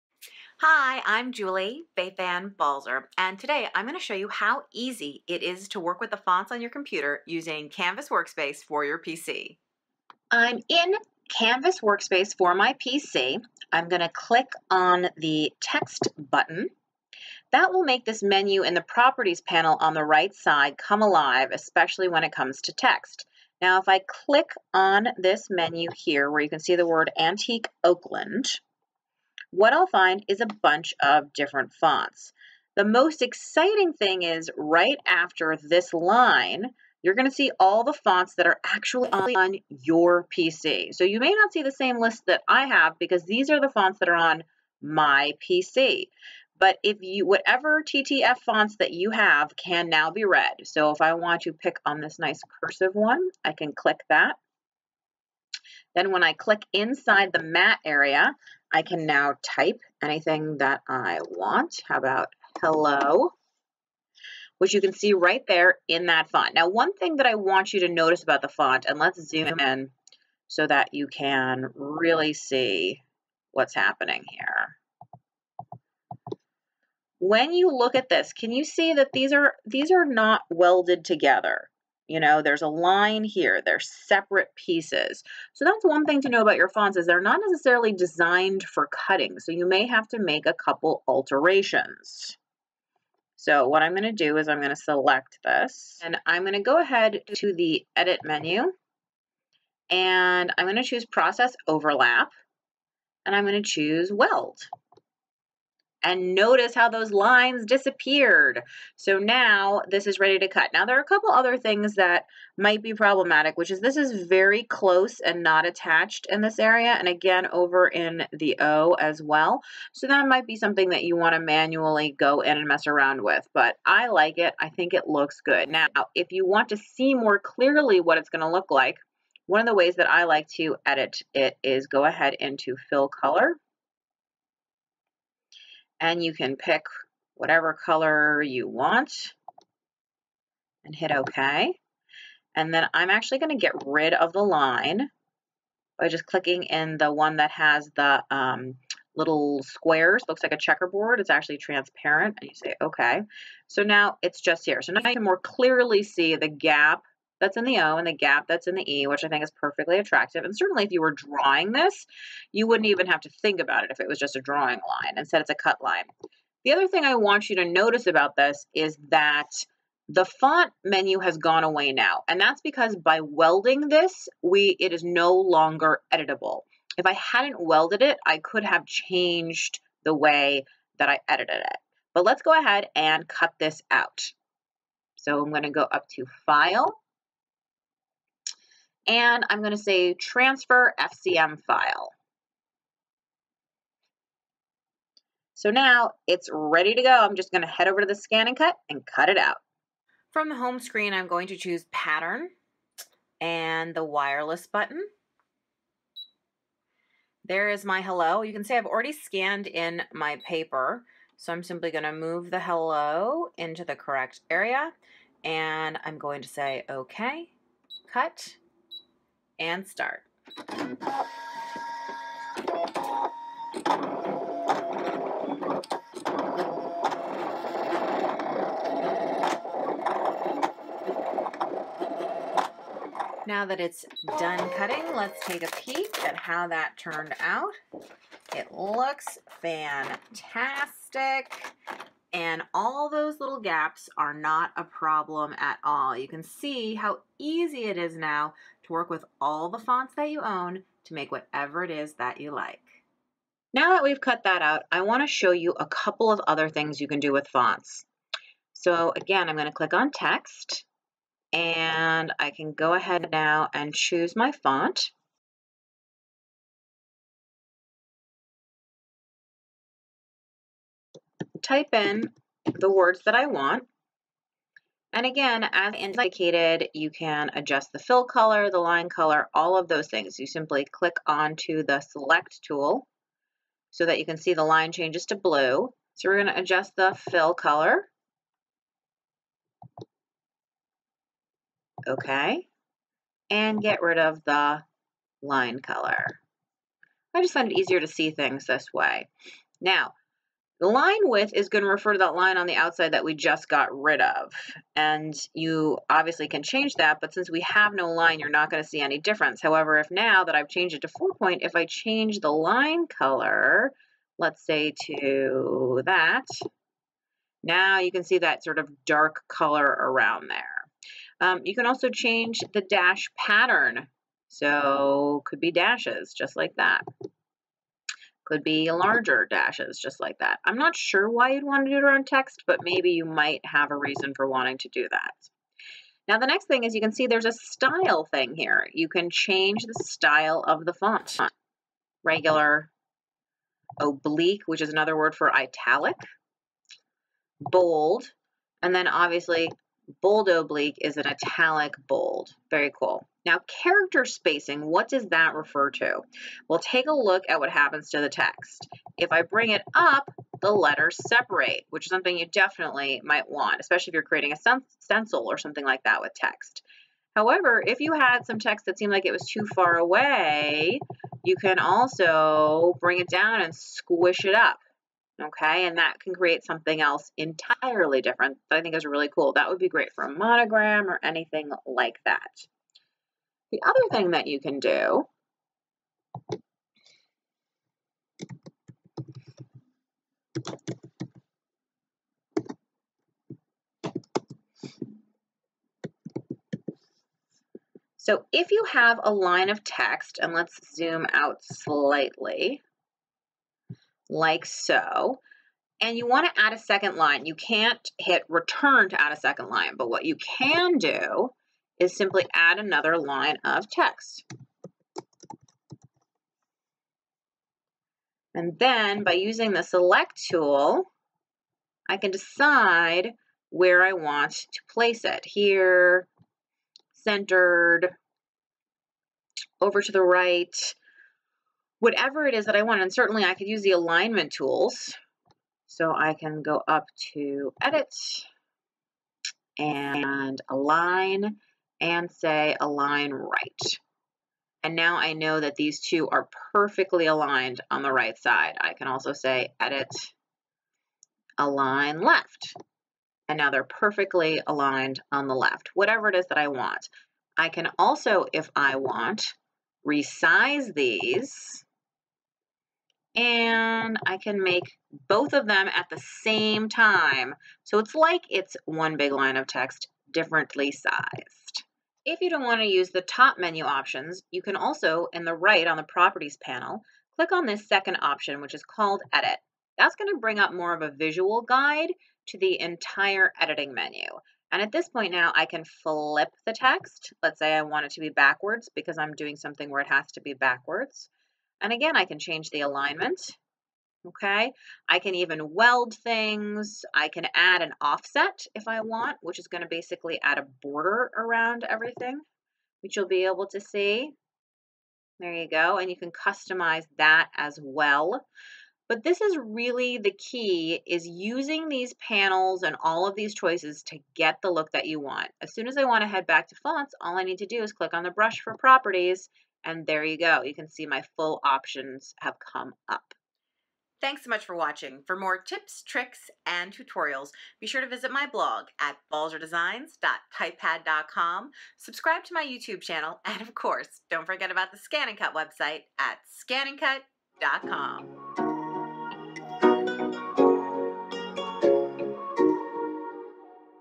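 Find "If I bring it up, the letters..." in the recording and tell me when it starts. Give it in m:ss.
5:59.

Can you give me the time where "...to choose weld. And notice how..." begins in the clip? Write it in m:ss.
1:43.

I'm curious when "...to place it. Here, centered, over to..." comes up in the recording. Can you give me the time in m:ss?
7:04.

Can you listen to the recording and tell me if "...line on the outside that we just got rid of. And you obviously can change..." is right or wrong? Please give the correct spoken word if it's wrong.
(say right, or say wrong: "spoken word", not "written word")
right.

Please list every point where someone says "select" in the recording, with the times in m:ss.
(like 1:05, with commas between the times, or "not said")
1:34, 4:41, 6:59.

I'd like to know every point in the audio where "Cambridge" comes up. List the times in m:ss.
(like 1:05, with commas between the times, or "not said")
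not said.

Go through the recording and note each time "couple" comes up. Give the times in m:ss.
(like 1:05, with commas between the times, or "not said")
1:30, 1:51, 4:15.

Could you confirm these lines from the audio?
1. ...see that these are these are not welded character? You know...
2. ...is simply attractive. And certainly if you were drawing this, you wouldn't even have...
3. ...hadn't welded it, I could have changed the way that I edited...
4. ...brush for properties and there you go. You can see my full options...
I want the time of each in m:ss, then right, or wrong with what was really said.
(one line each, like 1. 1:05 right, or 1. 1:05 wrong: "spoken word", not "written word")
1. 1:18 wrong: "together", not "character"
2. 2:39 wrong: "perfectly", not "simply"
3. 2:57 right
4. 8:38 right.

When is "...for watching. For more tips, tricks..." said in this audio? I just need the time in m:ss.
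8:44.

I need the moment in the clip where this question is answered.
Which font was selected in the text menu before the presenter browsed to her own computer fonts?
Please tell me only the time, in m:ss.
0:27.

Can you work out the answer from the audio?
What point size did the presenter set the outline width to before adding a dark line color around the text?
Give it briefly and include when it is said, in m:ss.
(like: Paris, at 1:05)
4, at 5:11.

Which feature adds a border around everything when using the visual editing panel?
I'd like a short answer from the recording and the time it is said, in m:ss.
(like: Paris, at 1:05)
offset, at 8:17.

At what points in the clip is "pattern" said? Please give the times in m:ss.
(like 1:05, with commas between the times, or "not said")
3:21, 5:23.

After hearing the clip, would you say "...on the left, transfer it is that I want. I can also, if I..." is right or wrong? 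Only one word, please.
wrong.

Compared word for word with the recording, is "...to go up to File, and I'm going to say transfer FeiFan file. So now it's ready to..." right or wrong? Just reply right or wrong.
wrong.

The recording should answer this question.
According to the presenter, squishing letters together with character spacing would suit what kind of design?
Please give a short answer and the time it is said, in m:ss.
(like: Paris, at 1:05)
monogram, at 6:20.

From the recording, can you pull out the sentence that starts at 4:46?
So we're going to adjust the fill color.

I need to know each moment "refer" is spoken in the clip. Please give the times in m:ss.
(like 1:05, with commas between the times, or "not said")
5:01, 5:55.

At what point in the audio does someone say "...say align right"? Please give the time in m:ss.
7:22.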